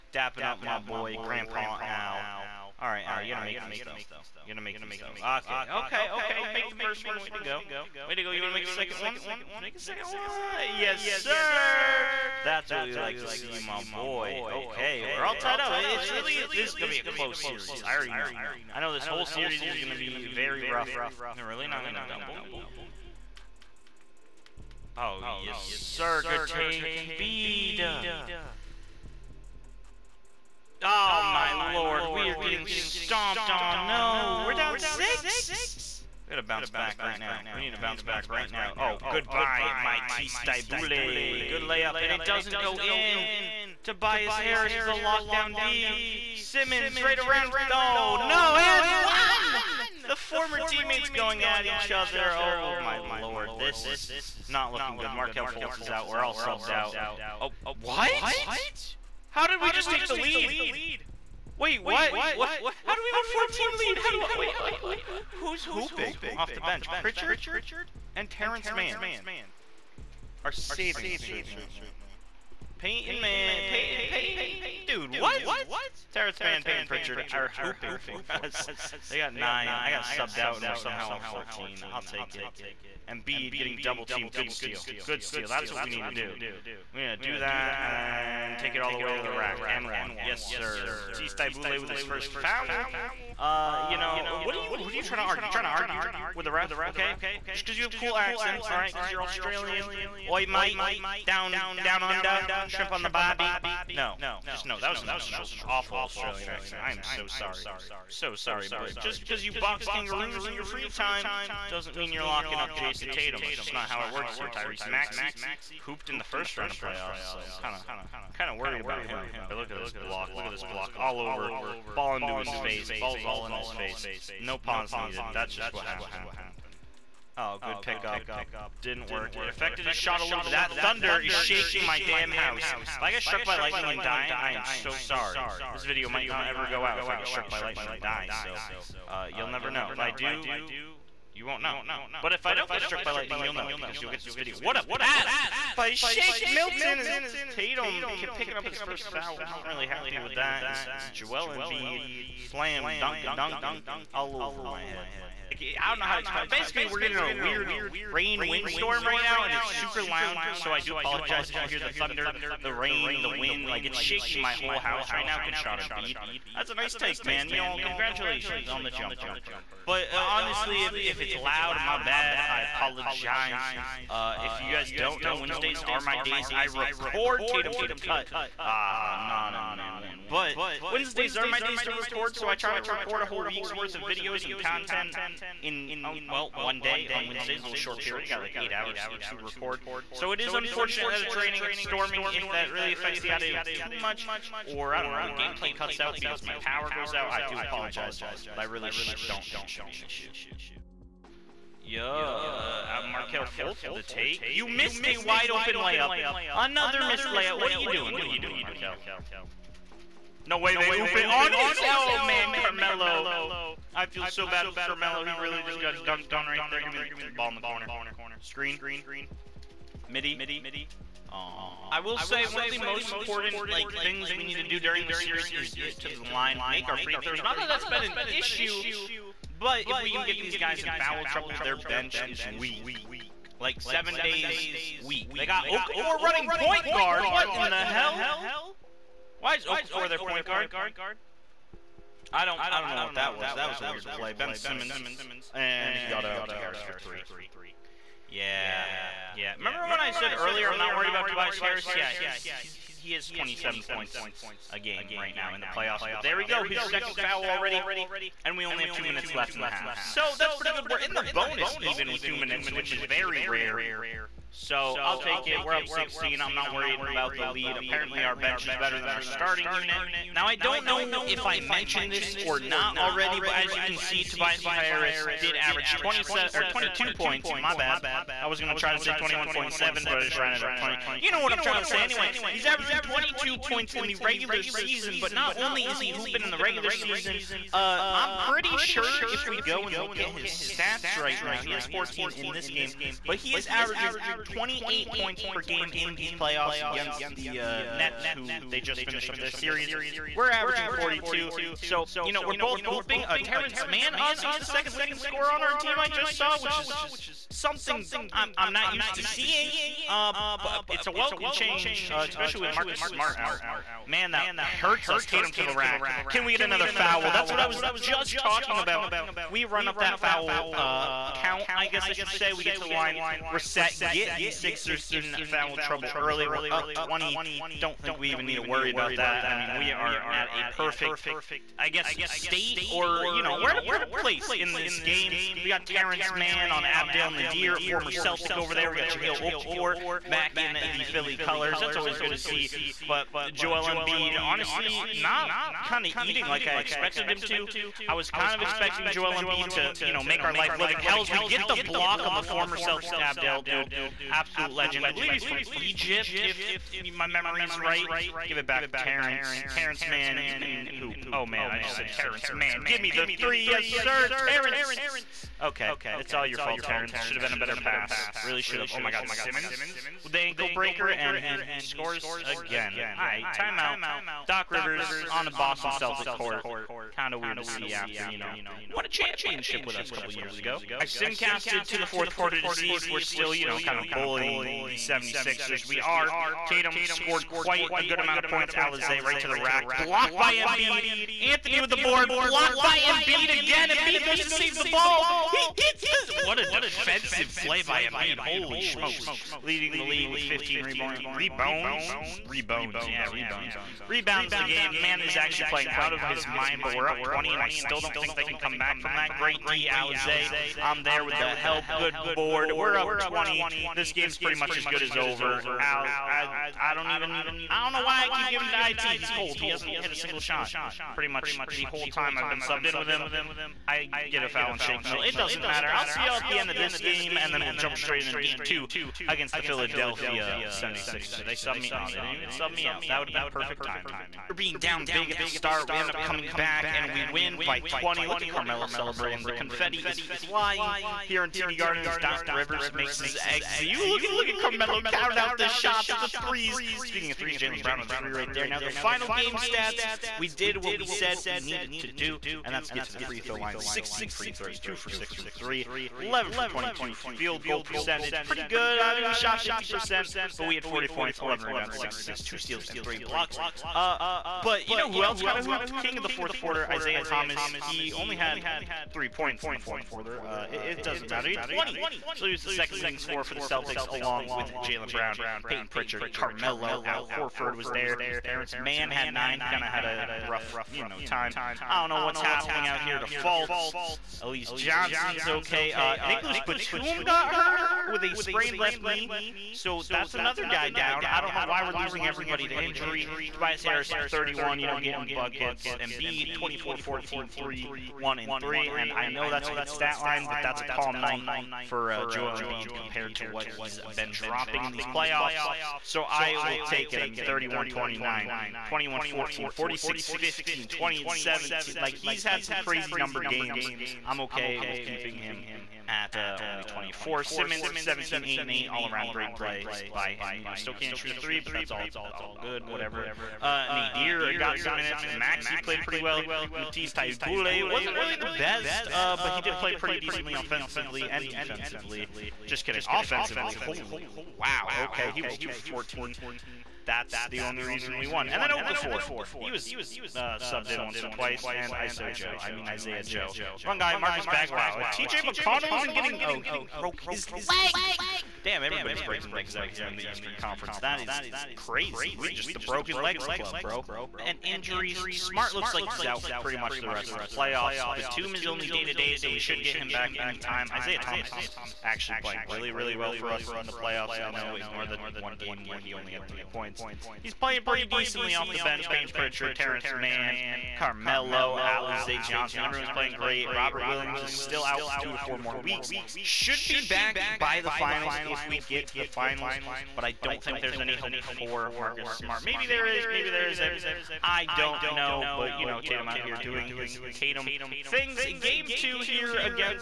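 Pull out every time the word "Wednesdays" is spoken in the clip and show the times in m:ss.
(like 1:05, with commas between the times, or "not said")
2:55, 3:00, 3:07.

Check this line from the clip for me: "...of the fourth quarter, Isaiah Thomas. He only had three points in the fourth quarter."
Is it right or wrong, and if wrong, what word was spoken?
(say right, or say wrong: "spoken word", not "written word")
right.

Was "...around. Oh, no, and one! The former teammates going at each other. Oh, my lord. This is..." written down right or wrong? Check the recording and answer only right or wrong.
right.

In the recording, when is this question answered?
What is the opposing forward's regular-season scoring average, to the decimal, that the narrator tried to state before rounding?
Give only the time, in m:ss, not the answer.
4:39.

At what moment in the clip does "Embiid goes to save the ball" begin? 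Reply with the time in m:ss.
6:33.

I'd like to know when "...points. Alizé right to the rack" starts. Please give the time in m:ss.
6:28.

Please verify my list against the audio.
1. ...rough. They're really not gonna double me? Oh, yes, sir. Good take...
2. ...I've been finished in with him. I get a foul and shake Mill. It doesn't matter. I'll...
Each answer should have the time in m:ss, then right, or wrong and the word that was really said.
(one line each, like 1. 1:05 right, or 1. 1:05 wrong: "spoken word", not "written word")
1. 0:20 right
2. 7:02 wrong: "subbed", not "finished".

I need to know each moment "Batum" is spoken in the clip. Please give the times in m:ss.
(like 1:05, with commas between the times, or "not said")
8:06, 9:18.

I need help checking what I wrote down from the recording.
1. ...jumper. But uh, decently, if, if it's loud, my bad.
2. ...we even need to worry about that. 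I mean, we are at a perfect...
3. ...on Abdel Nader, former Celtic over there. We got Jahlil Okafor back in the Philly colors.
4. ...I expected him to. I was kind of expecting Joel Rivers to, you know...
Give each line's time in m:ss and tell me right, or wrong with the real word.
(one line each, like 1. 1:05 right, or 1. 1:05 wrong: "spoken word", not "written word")
1. 2:48 wrong: "honestly", not "decently"
2. 5:28 right
3. 5:36 right
4. 5:46 wrong: "Embiid", not "Rivers".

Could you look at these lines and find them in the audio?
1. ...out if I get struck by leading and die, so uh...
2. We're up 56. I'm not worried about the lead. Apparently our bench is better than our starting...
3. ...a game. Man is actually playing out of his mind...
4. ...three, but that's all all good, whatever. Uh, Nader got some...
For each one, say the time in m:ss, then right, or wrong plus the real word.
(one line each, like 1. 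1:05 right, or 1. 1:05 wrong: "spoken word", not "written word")
1. 2:16 wrong: "lightning", not "leading"
2. 4:25 wrong: "16", not "56"
3. 6:44 right
4. 8:41 right.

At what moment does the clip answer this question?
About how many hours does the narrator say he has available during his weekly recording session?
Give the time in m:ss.
3:08.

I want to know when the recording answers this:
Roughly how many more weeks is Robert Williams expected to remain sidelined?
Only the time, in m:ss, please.
9:35.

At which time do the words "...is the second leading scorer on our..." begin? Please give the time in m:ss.
5:04.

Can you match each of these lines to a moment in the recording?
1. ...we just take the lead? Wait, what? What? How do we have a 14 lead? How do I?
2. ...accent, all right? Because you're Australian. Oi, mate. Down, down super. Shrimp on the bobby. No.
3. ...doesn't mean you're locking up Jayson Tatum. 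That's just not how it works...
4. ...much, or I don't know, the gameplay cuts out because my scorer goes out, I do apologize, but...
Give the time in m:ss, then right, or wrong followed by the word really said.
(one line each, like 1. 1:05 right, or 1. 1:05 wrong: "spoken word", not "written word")
1. 0:59 right
2. 1:38 wrong: "under", not "super"
3. 1:51 right
4. 3:13 wrong: "power", not "scorer".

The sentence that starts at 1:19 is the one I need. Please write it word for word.
I got subbed out, and we're somehow up 14.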